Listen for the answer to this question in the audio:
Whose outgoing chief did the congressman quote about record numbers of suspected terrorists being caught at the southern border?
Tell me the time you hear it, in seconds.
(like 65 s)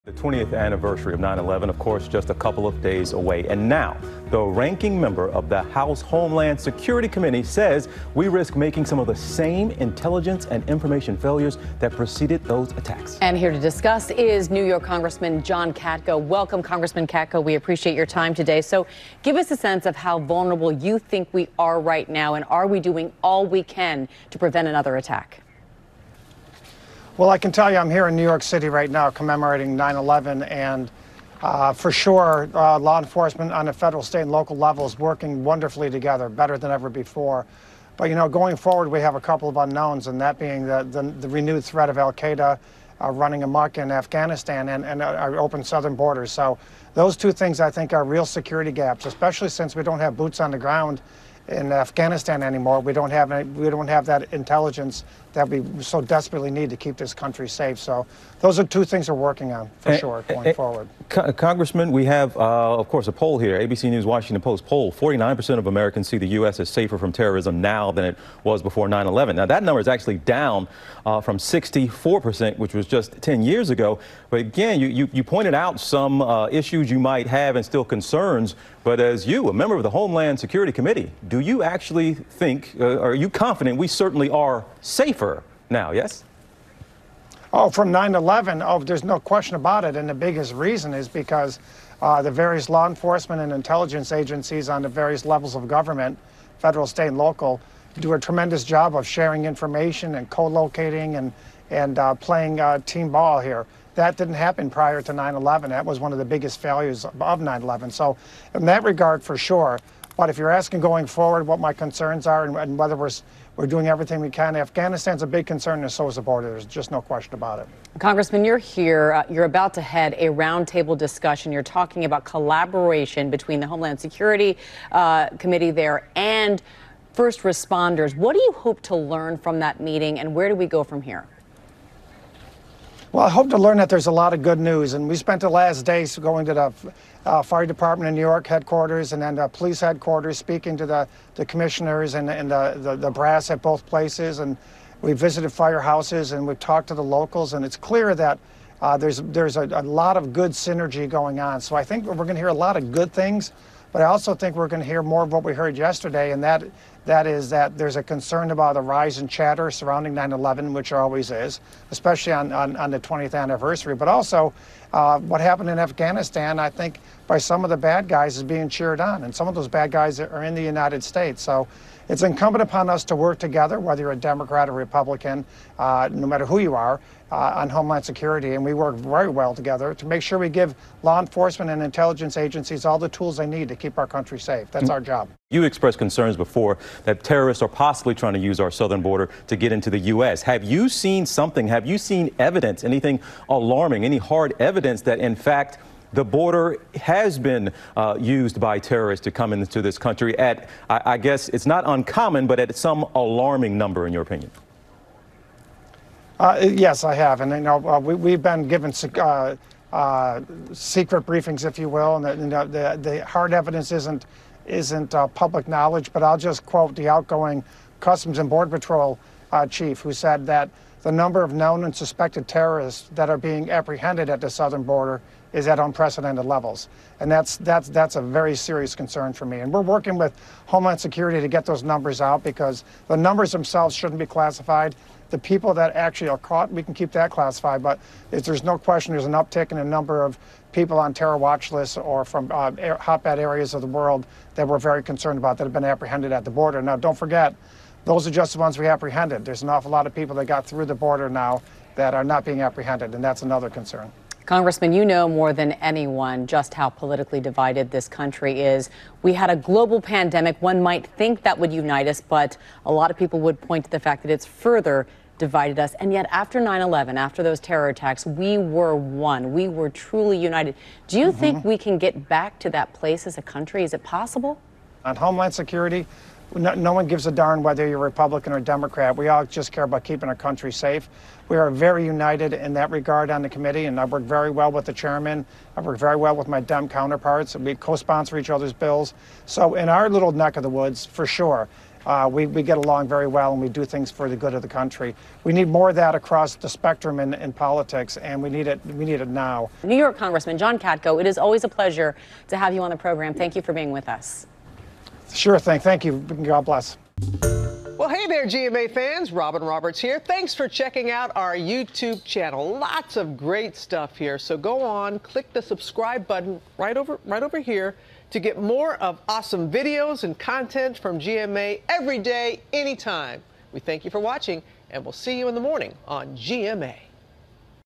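217 s.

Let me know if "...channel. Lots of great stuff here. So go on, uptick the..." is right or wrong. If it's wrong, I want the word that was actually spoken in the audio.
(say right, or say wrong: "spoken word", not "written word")
wrong: "click", not "uptick".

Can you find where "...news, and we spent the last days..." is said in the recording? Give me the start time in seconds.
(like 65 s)
134 s.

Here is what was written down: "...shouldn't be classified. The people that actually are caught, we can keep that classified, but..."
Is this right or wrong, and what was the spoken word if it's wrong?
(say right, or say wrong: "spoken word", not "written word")
right.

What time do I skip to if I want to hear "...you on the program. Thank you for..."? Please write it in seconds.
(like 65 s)
302 s.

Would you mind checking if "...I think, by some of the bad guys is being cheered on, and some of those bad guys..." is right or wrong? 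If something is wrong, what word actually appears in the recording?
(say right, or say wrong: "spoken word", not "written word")
right.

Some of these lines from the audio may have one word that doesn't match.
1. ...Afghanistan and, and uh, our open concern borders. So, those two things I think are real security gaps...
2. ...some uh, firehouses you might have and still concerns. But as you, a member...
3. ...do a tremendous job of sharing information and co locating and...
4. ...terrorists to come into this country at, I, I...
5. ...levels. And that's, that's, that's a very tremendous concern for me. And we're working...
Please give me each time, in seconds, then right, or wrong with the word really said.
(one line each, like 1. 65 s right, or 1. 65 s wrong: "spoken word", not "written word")
1. 43 s wrong: "southern", not "concern"
2. 75 s wrong: "issues", not "firehouses"
3. 97 s right
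4. 198 s right
5. 226 s wrong: "serious", not "tremendous".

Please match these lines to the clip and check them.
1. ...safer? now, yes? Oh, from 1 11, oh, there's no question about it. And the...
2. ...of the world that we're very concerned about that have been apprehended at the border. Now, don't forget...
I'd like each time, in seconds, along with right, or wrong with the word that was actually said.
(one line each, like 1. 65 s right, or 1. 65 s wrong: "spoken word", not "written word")
1. 84 s wrong: "9", not "1"
2. 243 s right.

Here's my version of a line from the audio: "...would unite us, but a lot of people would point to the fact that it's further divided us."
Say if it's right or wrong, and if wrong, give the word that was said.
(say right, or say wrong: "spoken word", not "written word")
right.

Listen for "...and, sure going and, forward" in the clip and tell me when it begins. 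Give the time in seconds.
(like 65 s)
59 s.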